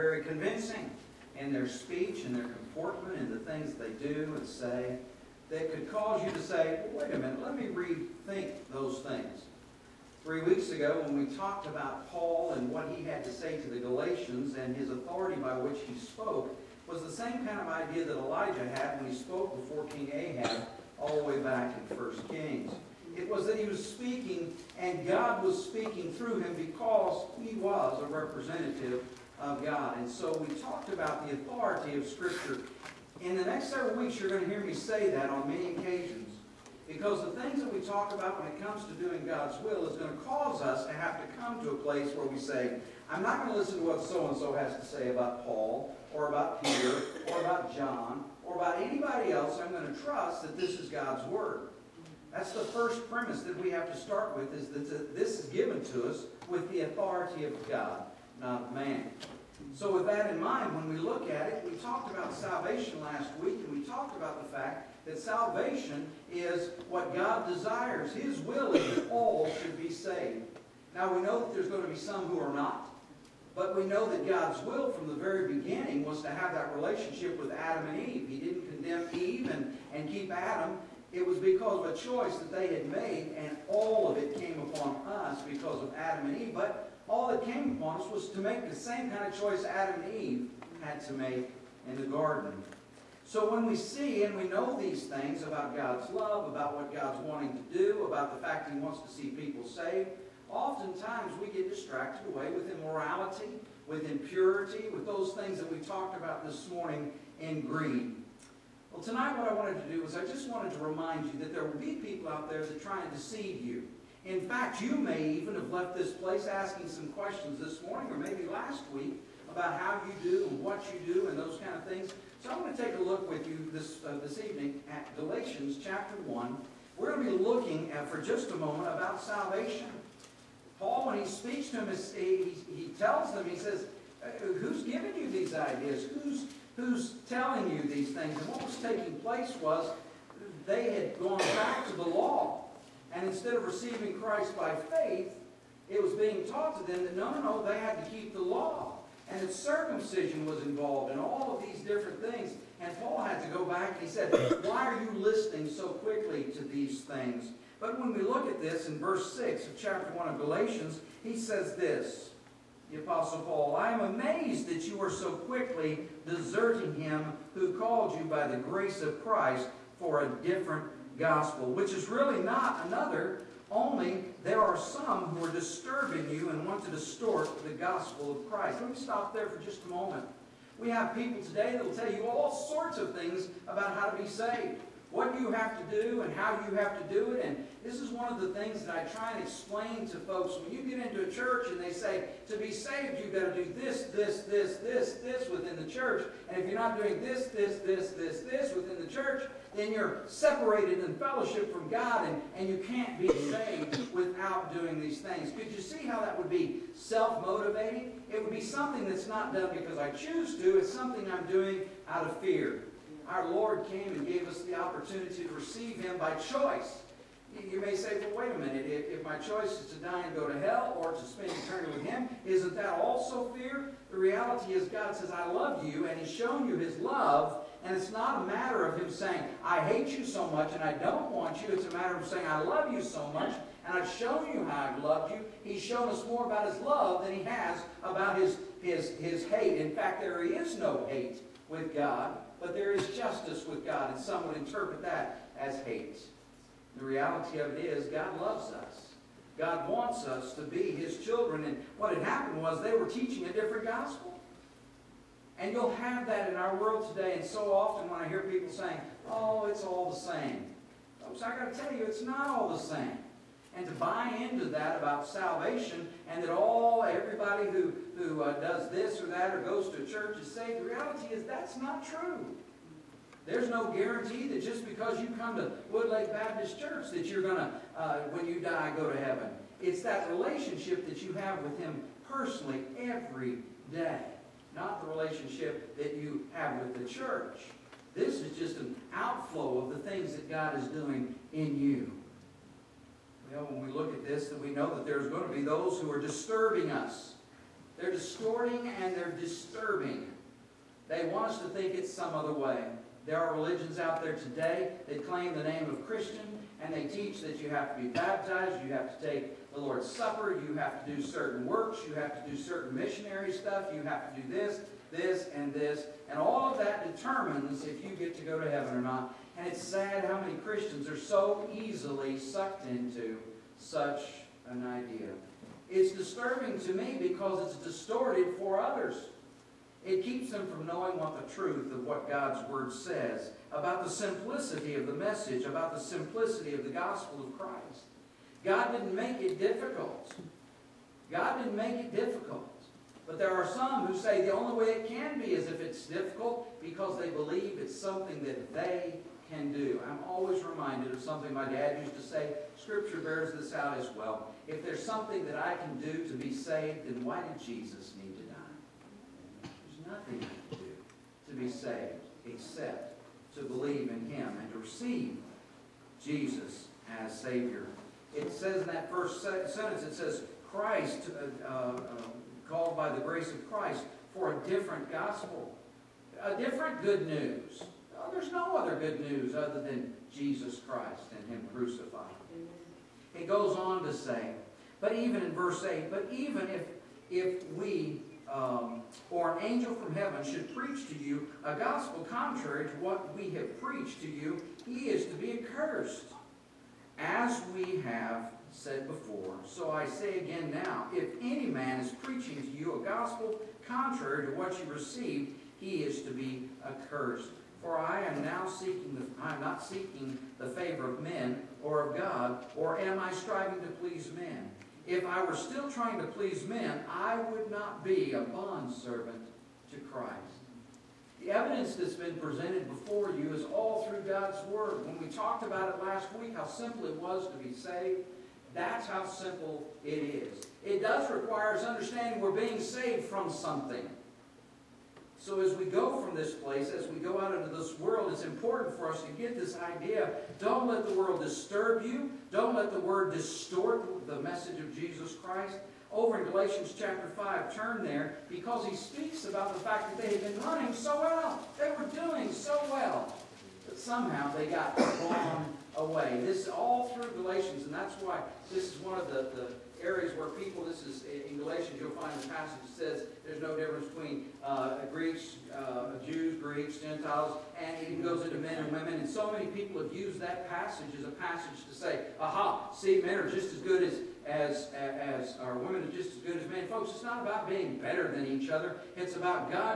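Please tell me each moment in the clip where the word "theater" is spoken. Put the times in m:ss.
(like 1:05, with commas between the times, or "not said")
not said.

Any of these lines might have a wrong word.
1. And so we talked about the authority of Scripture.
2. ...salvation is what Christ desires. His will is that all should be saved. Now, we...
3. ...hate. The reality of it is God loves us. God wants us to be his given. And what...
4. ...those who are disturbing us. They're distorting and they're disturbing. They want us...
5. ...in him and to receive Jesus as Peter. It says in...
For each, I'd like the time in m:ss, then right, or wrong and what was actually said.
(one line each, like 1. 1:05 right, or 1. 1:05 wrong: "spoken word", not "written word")
1. 0:29 right
2. 1:05 wrong: "God", not "Christ"
3. 4:05 wrong: "children", not "given"
4. 4:55 right
5. 6:04 wrong: "Savior", not "Peter".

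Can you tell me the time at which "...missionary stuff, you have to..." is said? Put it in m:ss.
5:12.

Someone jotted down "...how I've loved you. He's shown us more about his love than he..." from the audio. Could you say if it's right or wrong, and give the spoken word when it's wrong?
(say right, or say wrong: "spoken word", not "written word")
right.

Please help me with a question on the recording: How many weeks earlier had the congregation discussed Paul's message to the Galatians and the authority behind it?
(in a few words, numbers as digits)
Three.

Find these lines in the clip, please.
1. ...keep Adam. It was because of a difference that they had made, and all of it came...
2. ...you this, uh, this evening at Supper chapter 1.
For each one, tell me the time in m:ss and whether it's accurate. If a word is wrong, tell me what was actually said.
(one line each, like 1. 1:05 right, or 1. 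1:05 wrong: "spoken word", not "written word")
1. 1:20 wrong: "choice", not "difference"
2. 2:03 wrong: "Galatians", not "Supper".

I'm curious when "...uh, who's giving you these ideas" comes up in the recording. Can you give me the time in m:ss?
2:14.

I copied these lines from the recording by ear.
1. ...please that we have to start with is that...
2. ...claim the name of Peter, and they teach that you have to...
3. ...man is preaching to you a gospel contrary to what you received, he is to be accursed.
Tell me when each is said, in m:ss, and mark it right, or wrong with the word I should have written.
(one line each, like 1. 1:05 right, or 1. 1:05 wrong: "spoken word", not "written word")
1. 0:53 wrong: "premise", not "please"
2. 5:05 wrong: "Christian", not "Peter"
3. 6:41 right.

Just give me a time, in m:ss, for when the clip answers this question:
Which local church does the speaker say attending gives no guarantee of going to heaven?
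4:35.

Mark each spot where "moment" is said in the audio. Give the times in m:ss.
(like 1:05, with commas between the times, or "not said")
2:08, 2:59.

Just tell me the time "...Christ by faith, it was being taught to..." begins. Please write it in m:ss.
2:24.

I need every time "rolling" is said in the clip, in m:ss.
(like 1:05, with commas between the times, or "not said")
not said.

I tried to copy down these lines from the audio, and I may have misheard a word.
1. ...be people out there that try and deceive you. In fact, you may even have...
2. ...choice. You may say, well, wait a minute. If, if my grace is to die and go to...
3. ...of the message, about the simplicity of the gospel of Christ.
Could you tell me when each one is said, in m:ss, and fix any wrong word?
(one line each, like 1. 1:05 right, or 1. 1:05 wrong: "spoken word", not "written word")
1. 1:51 right
2. 3:36 wrong: "choice", not "grace"
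3. 5:34 right.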